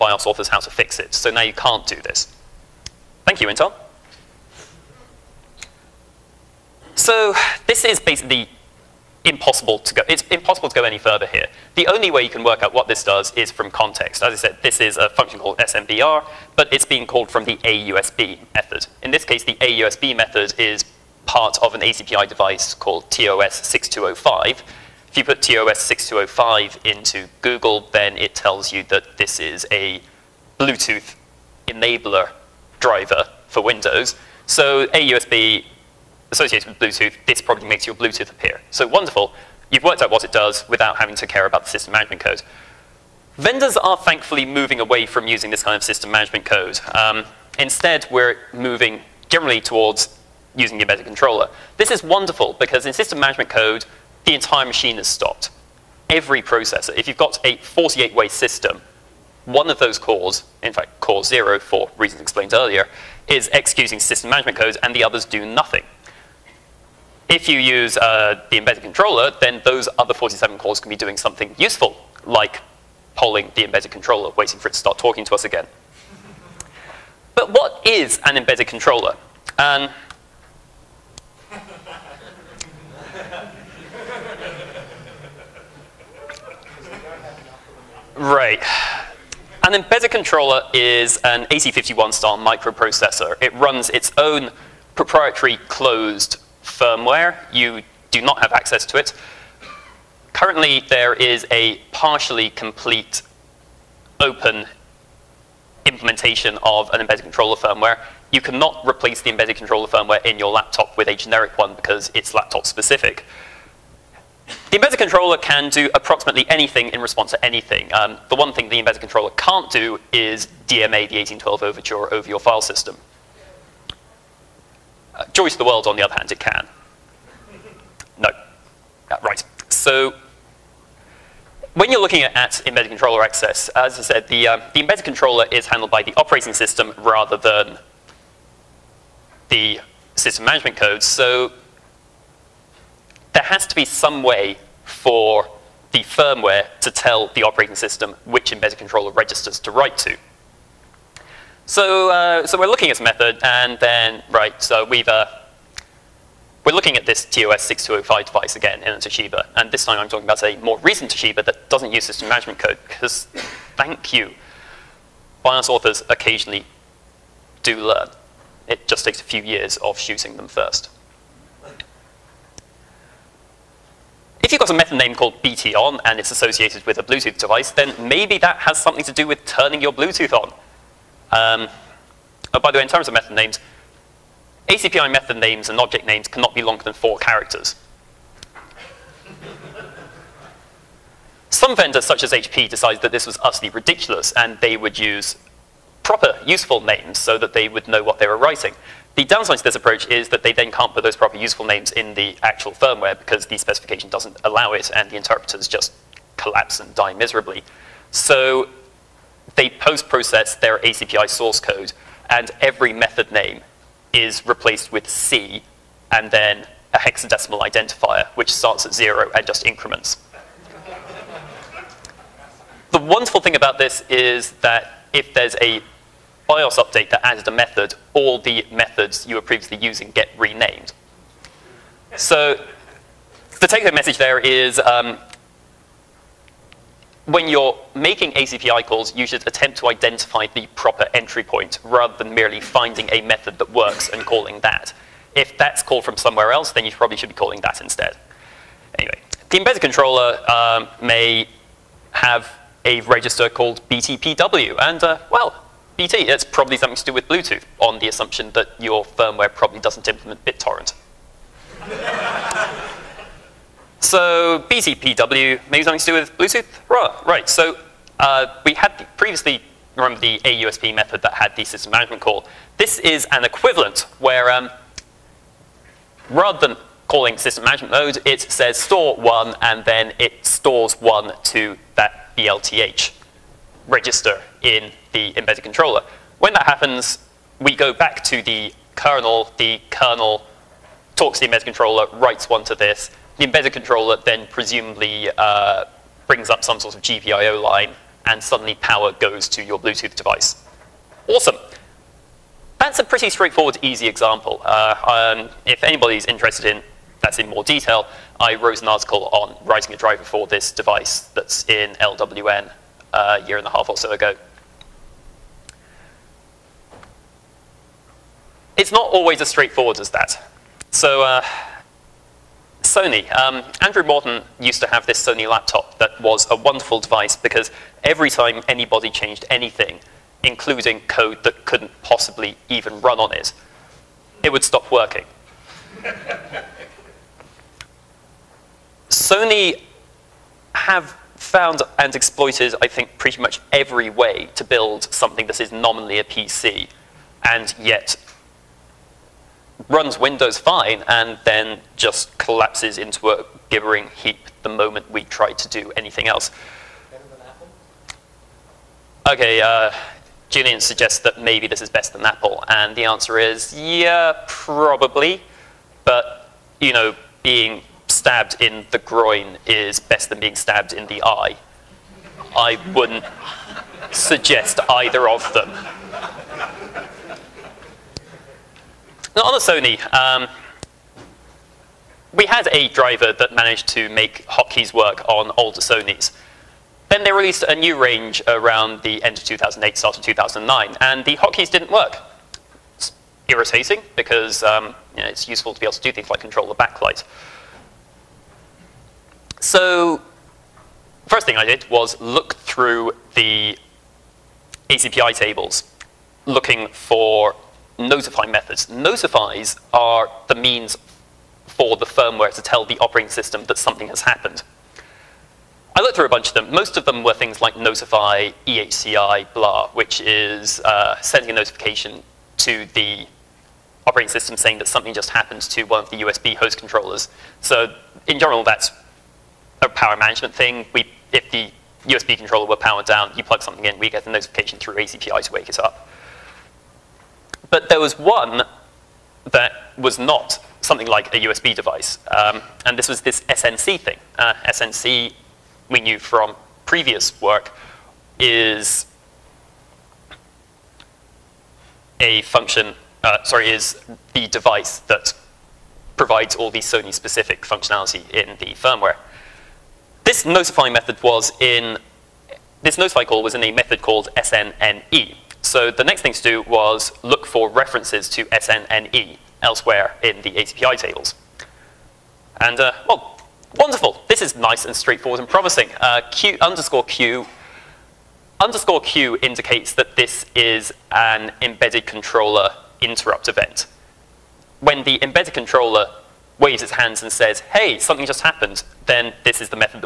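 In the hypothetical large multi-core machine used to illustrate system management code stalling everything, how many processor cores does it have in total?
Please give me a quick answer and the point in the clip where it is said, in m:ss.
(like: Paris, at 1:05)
48, at 0:57.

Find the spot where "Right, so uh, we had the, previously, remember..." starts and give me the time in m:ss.
4:27.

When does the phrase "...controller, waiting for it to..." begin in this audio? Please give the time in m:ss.
1:13.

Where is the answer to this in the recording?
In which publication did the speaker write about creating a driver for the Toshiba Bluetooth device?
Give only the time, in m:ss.
5:11.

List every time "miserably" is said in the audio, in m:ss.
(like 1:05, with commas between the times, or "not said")
3:27.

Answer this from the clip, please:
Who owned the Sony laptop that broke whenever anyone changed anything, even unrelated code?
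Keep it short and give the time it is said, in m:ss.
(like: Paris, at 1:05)
Andrew Morton, at 5:23.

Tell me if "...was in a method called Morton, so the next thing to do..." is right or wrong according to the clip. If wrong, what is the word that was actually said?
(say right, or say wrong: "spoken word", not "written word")
wrong: "SNNE", not "Morton".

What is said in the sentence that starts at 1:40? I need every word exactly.
Currently, there is a partially complete open implementation of an embedded controller firmware.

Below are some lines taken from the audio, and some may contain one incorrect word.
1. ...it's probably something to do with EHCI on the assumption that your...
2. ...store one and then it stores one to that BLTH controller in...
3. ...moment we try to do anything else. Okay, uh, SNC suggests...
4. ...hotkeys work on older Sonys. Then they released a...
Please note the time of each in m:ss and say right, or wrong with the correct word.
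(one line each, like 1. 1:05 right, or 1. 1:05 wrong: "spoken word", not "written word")
1. 4:16 wrong: "Bluetooth", not "EHCI"
2. 4:38 wrong: "register", not "controller"
3. 5:54 wrong: "Julian", not "SNC"
4. 6:24 right.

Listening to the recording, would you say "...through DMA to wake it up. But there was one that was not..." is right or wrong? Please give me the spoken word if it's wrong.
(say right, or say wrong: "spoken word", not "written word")
wrong: "ACPI", not "DMA".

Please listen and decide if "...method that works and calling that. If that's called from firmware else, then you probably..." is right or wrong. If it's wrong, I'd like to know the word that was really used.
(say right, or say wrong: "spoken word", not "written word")
wrong: "somewhere", not "firmware".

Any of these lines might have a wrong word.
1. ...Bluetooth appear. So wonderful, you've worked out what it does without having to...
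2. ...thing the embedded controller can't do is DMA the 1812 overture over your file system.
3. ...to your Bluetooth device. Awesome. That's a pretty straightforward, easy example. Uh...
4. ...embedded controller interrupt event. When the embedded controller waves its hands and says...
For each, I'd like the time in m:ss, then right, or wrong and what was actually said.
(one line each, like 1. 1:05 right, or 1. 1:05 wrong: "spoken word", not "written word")
1. 0:37 right
2. 1:58 right
3. 4:59 right
4. 8:01 right.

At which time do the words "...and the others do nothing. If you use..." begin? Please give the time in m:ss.
1:04.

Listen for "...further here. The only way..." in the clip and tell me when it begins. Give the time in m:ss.
0:10.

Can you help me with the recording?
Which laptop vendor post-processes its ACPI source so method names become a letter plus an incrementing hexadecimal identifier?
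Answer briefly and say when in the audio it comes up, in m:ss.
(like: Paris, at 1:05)
HP, at 3:12.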